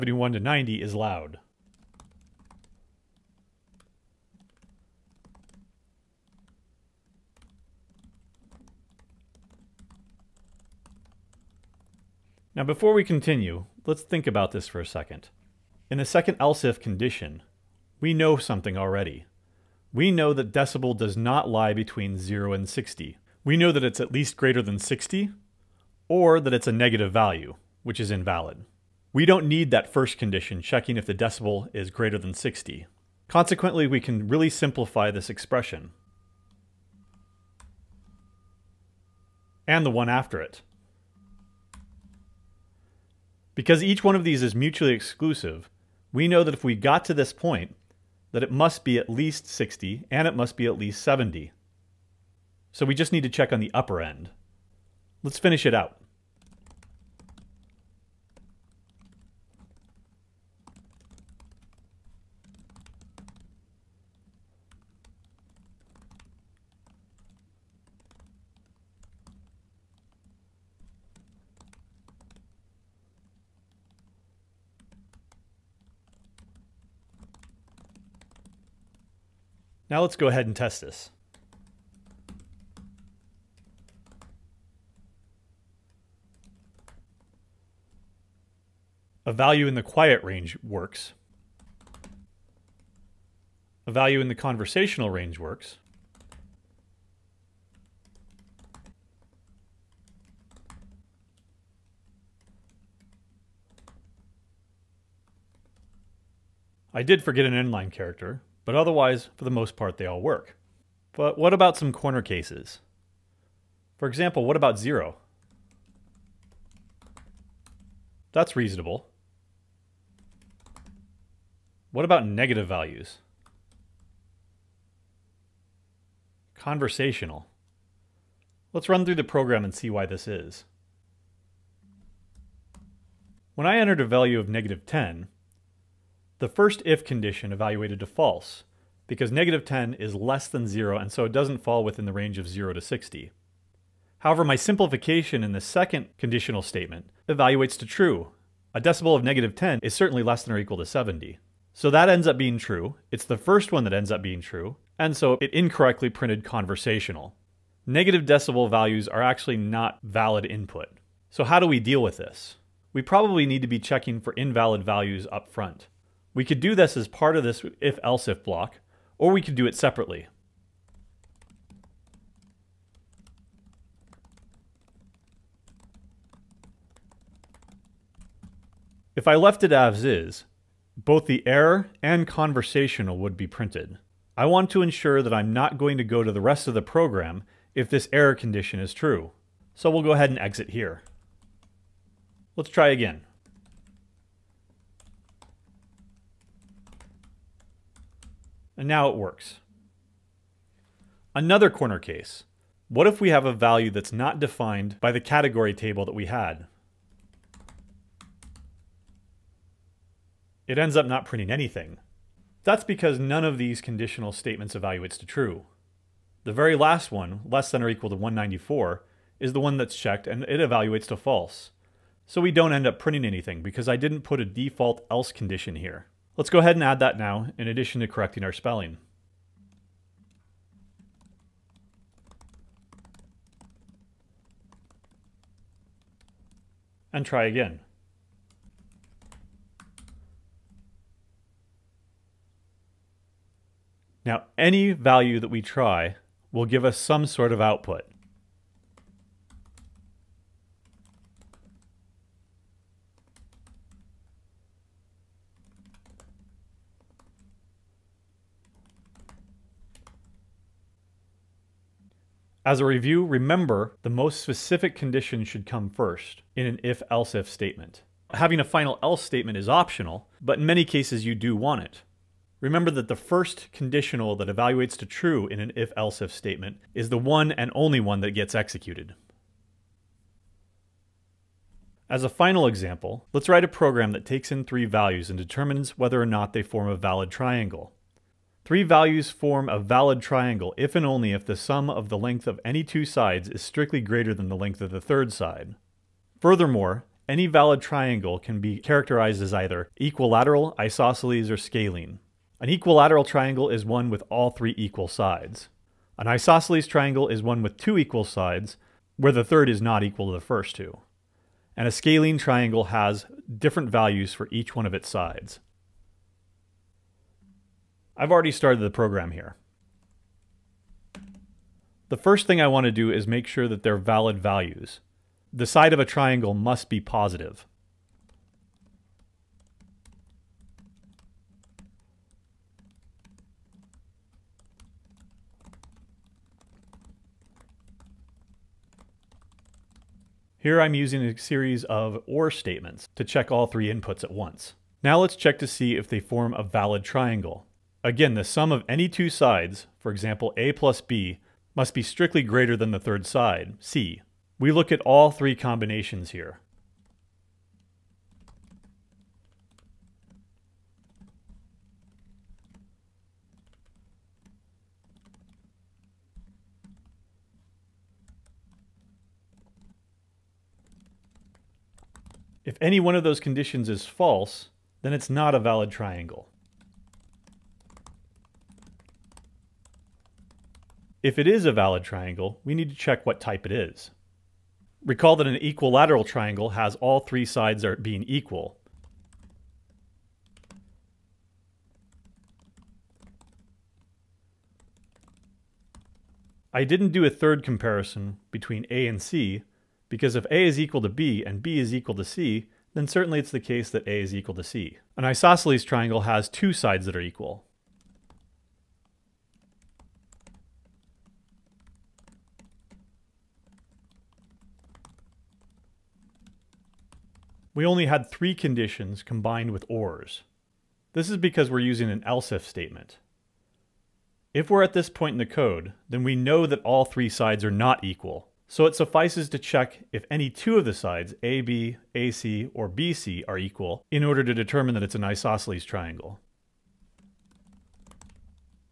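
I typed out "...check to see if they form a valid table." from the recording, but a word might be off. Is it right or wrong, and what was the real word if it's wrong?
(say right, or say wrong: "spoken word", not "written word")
wrong: "triangle", not "table".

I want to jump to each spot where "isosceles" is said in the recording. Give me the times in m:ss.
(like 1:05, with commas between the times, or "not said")
5:00, 5:06, 6:45, 7:15.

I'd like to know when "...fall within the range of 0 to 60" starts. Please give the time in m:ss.
2:21.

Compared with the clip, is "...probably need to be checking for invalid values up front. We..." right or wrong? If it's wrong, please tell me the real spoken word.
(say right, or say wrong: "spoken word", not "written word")
right.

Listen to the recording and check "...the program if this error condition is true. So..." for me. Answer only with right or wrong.
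right.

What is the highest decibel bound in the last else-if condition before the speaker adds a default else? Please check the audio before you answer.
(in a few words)
194.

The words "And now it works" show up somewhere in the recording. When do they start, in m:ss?
3:18.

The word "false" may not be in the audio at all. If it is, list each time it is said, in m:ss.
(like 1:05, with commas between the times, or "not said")
2:18, 3:41, 6:14.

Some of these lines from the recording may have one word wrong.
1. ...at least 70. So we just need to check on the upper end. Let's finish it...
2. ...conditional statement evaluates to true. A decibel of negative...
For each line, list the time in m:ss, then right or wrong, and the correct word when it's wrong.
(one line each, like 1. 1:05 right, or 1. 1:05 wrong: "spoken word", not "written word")
1. 0:50 right
2. 2:26 right.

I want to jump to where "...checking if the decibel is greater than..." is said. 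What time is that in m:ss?
0:30.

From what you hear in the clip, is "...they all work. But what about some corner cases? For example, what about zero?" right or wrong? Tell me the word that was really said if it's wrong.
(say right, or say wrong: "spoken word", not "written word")
right.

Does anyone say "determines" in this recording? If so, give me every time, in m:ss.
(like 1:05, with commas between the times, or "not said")
4:45, 7:14.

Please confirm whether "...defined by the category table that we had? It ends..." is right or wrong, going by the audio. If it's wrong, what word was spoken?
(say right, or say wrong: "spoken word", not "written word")
right.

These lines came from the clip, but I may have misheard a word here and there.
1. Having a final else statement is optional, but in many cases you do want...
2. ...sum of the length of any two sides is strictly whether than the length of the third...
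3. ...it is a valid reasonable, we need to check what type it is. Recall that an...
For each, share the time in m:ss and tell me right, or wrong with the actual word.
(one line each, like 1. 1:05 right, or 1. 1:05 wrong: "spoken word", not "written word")
1. 4:28 right
2. 4:51 wrong: "greater", not "whether"
3. 6:21 wrong: "triangle", not "reasonable".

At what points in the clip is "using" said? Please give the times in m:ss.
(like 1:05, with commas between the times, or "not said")
5:40, 7:01.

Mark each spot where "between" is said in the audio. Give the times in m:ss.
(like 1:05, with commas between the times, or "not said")
0:21, 6:38.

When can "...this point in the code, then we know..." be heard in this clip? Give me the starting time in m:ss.
7:04.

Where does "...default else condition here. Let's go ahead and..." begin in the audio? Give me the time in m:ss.
3:44.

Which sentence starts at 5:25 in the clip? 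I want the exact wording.
The side of a triangle must be positive.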